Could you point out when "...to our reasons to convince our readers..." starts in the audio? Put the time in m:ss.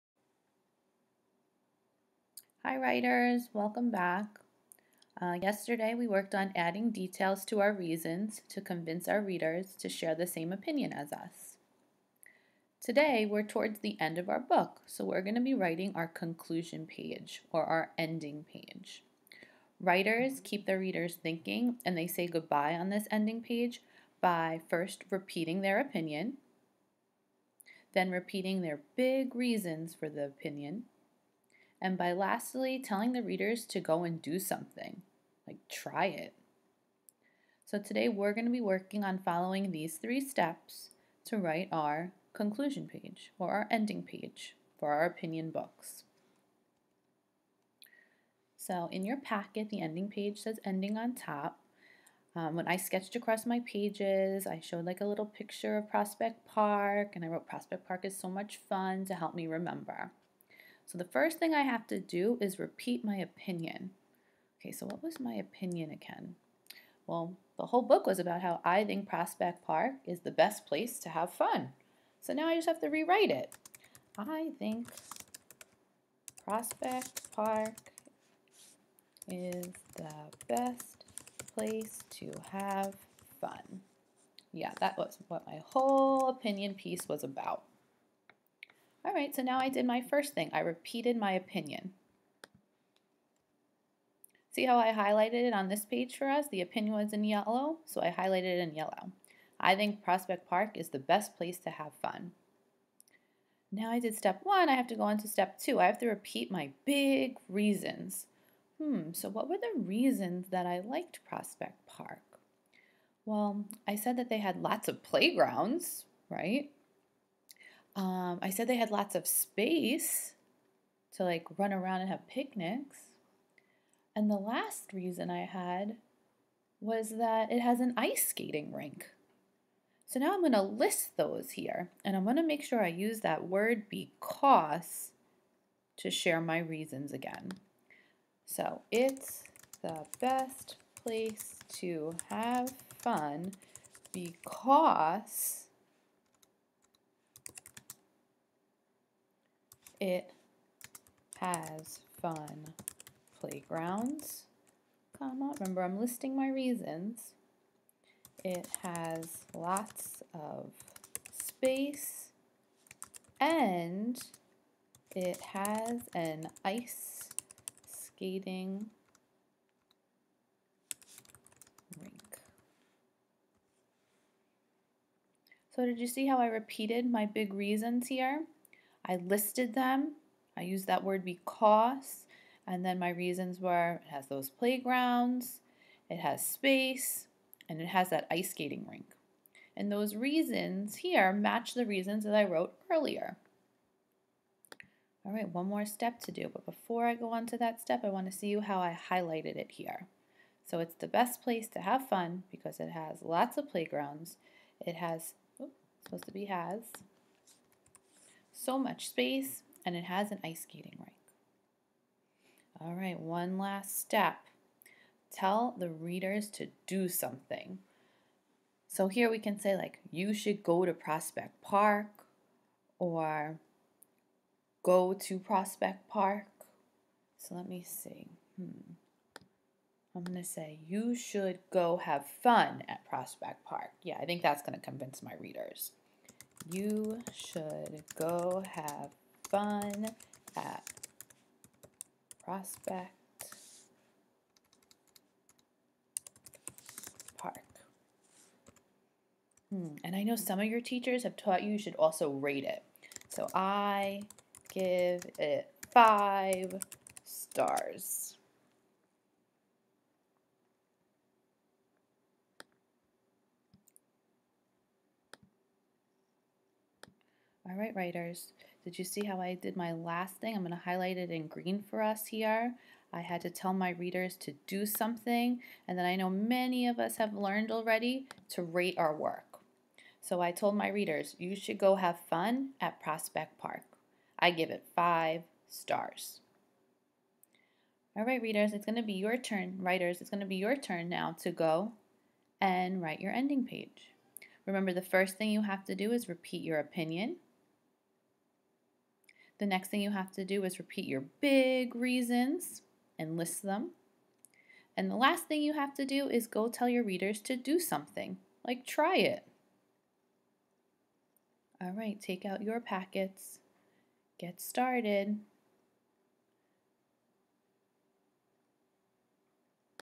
0:07.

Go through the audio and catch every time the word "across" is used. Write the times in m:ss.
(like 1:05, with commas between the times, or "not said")
0:53.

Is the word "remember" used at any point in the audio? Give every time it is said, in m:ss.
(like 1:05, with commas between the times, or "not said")
0:59, 2:35, 4:54.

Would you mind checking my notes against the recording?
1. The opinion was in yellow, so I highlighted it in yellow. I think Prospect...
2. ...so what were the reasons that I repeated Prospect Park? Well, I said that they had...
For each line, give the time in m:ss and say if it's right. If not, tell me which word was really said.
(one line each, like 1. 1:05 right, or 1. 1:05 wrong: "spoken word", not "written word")
1. 1:36 right
2. 1:49 wrong: "liked", not "repeated".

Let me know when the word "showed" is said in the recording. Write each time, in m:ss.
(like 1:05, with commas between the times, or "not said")
0:54.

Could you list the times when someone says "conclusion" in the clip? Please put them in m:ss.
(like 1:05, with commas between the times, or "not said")
0:16, 0:42.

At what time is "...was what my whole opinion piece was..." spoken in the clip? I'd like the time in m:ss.
1:24.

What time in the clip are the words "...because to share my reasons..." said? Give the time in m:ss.
2:13.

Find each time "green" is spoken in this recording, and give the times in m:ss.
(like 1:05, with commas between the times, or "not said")
4:31.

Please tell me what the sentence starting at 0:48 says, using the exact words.
So in your packet, the ending page says ending on top.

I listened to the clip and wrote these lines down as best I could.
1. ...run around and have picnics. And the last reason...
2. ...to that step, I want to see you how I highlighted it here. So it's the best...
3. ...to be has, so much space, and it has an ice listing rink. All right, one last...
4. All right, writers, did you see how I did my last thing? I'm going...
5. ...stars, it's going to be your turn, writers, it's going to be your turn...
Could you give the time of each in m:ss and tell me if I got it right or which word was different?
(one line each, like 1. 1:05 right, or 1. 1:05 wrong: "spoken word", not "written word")
1. 2:01 right
2. 3:17 right
3. 3:26 wrong: "skating", not "listing"
4. 4:27 right
5. 4:48 wrong: "readers", not "stars".